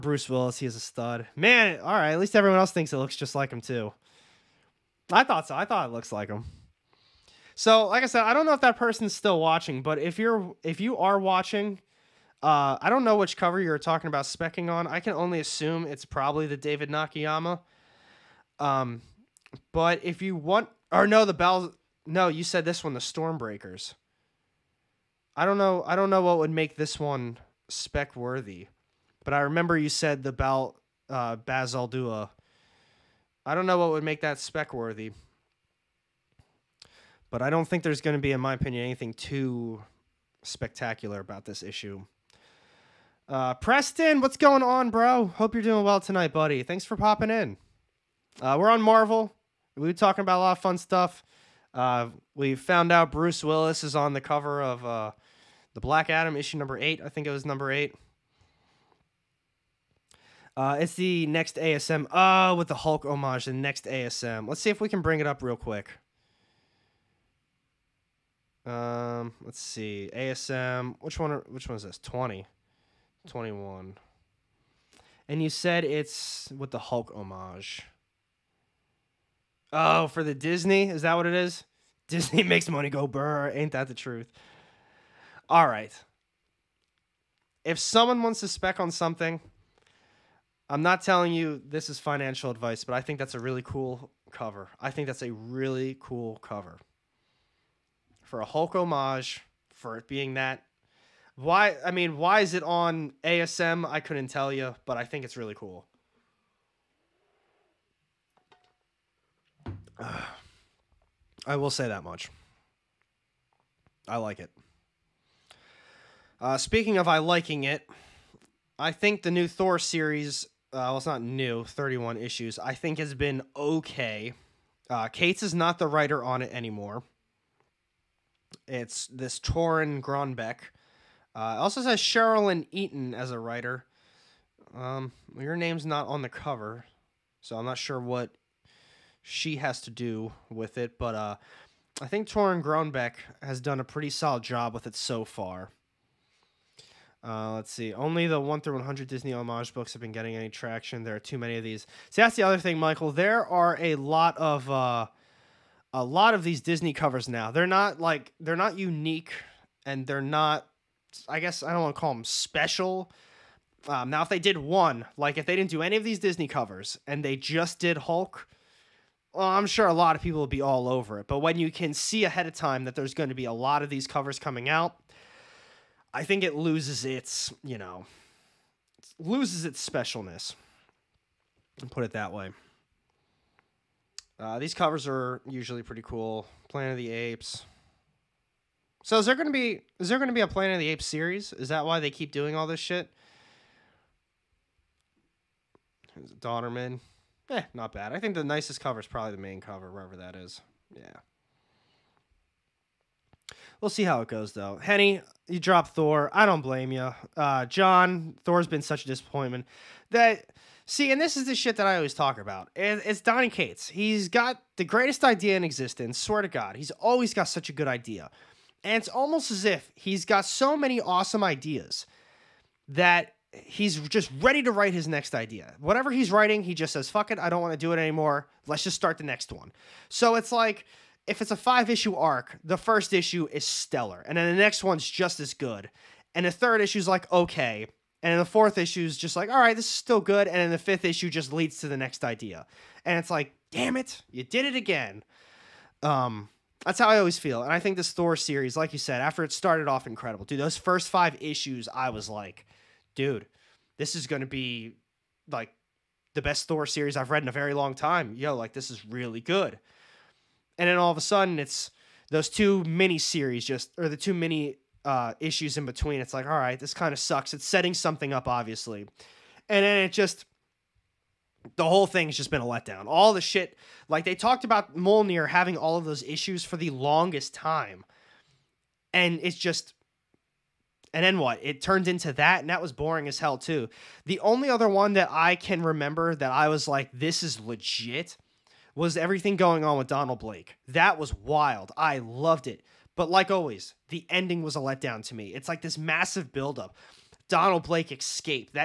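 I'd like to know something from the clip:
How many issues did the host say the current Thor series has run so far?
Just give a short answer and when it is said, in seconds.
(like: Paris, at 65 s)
31, at 121 s.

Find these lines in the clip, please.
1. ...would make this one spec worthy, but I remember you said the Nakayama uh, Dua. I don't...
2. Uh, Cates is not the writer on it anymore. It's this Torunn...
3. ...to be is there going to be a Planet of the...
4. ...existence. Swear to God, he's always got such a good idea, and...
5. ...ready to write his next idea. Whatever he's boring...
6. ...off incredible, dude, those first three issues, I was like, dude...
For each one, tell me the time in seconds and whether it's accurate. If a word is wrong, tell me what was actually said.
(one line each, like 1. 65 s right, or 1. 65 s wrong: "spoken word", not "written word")
1. 26 s wrong: "Bal", not "Nakayama"
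2. 124 s right
3. 189 s right
4. 215 s right
5. 224 s wrong: "writing", not "boring"
6. 249 s wrong: "five", not "three".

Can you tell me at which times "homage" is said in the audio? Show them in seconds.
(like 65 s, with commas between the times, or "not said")
63 s, 77 s, 98 s, 149 s.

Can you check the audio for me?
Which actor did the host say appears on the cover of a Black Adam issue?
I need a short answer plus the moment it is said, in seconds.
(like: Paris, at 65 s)
Bruce Willis, at 53 s.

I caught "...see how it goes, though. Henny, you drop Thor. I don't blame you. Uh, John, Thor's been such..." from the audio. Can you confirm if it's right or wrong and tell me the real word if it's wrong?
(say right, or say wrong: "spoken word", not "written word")
right.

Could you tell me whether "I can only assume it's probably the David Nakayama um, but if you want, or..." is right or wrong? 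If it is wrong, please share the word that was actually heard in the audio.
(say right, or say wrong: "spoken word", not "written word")
right.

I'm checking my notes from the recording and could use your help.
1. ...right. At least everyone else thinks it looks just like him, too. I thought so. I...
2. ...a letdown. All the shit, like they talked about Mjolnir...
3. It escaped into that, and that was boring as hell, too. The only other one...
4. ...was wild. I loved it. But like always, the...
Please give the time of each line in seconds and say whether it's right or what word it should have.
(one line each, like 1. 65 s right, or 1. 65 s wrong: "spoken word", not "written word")
1. 1 s right
2. 272 s right
3. 281 s wrong: "turned", not "escaped"
4. 291 s right.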